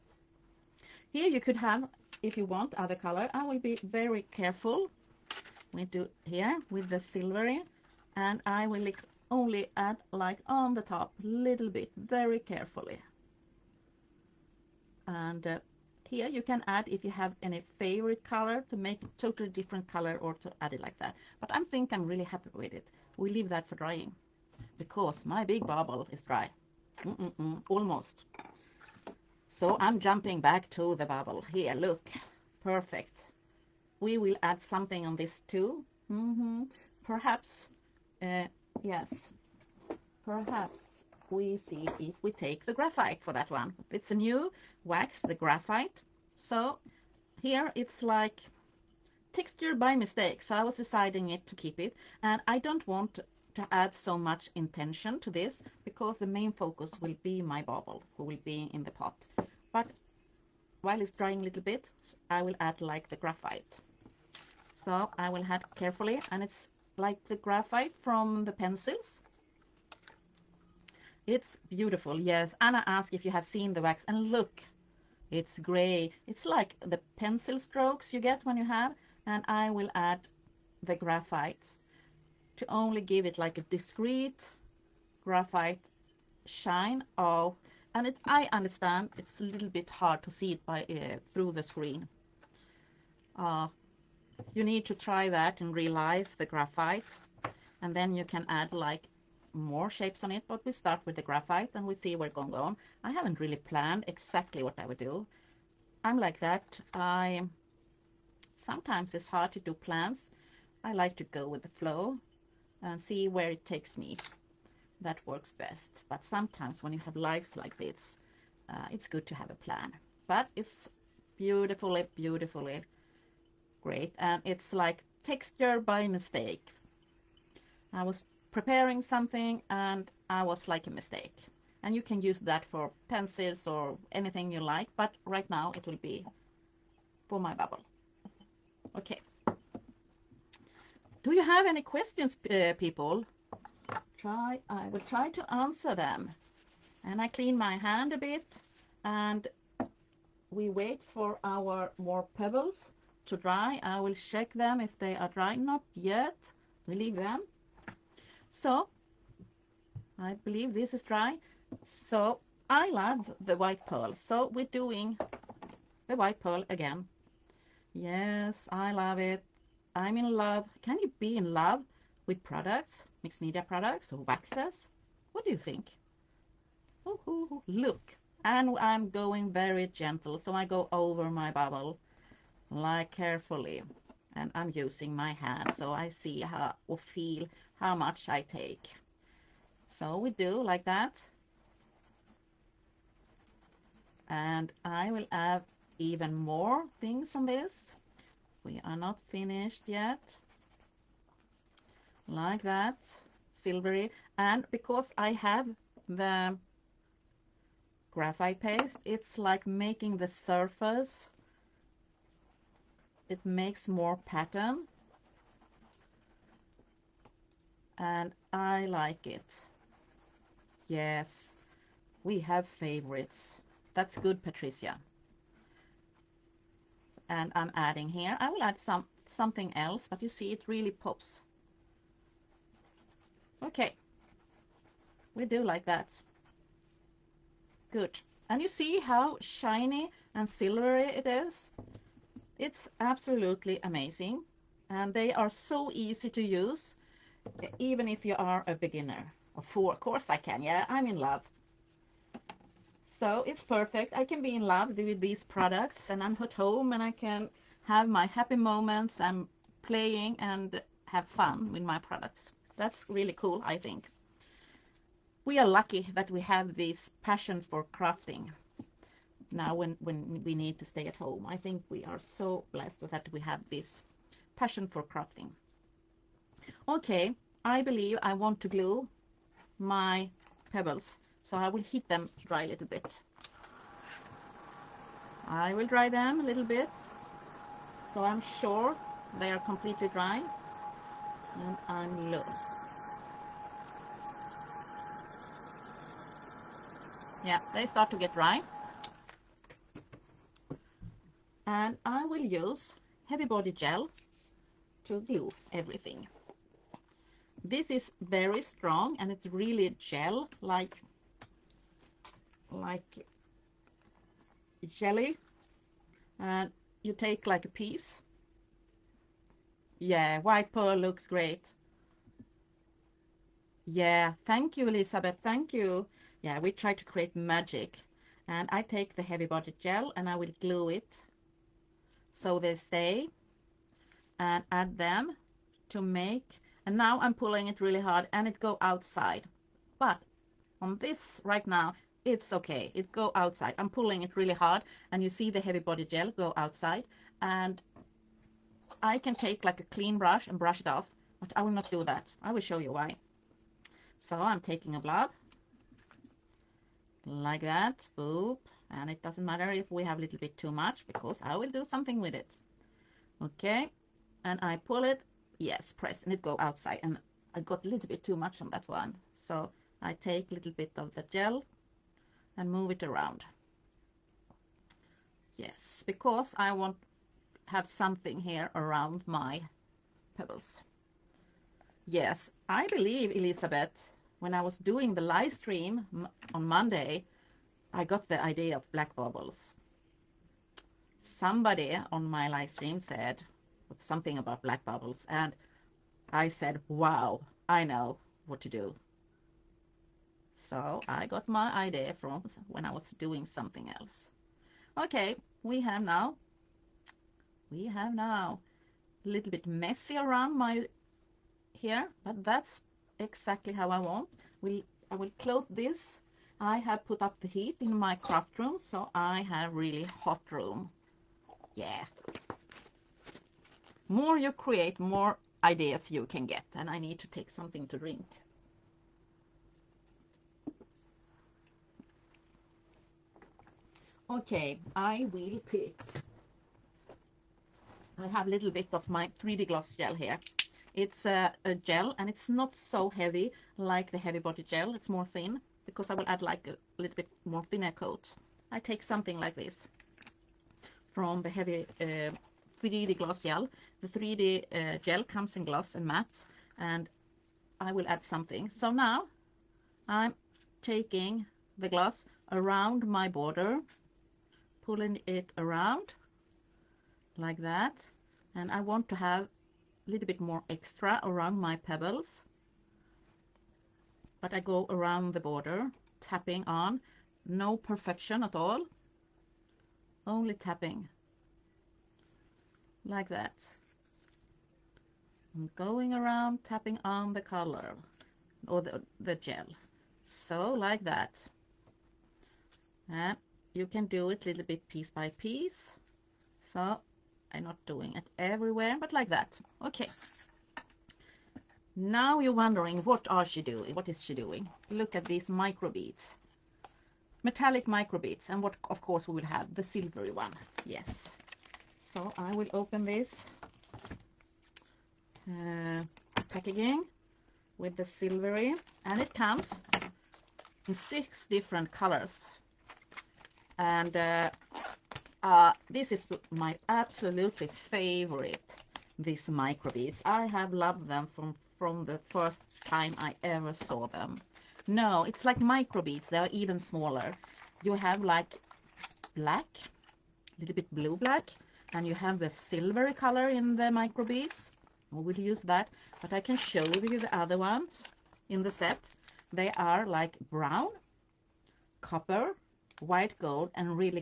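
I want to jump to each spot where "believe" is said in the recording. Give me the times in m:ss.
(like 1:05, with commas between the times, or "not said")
2:40, 4:37, 6:22.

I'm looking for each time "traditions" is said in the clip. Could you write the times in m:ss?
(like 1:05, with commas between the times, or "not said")
not said.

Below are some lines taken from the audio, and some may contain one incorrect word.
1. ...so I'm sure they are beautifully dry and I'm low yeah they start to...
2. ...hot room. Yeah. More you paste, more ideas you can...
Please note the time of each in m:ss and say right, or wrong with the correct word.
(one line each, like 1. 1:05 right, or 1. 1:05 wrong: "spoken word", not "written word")
1. 4:48 wrong: "completely", not "beautifully"
2. 7:00 wrong: "create", not "paste".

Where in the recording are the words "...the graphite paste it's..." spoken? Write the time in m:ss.
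3:26.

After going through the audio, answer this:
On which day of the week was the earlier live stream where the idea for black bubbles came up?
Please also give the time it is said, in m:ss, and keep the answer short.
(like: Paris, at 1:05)
Monday, at 6:26.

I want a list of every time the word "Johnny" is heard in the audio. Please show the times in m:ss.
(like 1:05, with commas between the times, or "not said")
not said.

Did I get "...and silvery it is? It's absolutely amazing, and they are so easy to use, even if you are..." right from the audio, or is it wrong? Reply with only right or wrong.
right.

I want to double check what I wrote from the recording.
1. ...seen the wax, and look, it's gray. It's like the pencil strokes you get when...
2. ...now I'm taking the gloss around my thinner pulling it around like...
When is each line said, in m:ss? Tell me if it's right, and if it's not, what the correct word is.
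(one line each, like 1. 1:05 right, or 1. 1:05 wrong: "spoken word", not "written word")
1. 1:13 right
2. 7:38 wrong: "border", not "thinner".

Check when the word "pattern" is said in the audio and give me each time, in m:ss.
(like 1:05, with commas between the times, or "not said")
3:34.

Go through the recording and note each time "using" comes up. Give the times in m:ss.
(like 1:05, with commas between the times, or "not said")
3:04.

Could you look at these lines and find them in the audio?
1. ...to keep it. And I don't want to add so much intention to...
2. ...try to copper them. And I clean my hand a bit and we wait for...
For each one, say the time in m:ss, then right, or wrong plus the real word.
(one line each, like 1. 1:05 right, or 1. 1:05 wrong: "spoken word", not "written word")
1. 0:51 right
2. 2:25 wrong: "answer", not "copper".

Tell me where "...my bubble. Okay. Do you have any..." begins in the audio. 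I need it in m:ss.
2:17.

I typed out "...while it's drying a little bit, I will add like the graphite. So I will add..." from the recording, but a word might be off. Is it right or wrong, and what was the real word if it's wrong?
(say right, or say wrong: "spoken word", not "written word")
right.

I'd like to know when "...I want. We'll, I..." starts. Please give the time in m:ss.
6:53.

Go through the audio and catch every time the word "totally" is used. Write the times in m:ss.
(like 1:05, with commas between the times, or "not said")
0:19.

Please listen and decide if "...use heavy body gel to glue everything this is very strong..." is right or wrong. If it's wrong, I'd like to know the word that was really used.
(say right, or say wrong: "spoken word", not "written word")
right.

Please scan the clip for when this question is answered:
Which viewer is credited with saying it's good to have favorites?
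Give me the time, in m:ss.
3:44.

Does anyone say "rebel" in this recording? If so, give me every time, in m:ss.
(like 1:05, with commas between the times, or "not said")
not said.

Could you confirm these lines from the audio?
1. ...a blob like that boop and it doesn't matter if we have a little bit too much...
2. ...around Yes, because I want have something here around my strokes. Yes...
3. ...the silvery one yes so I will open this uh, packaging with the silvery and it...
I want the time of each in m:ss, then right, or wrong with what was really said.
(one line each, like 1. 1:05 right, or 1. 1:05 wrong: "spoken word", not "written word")
1. 5:54 right
2. 6:13 wrong: "pebbles", not "strokes"
3. 8:29 right.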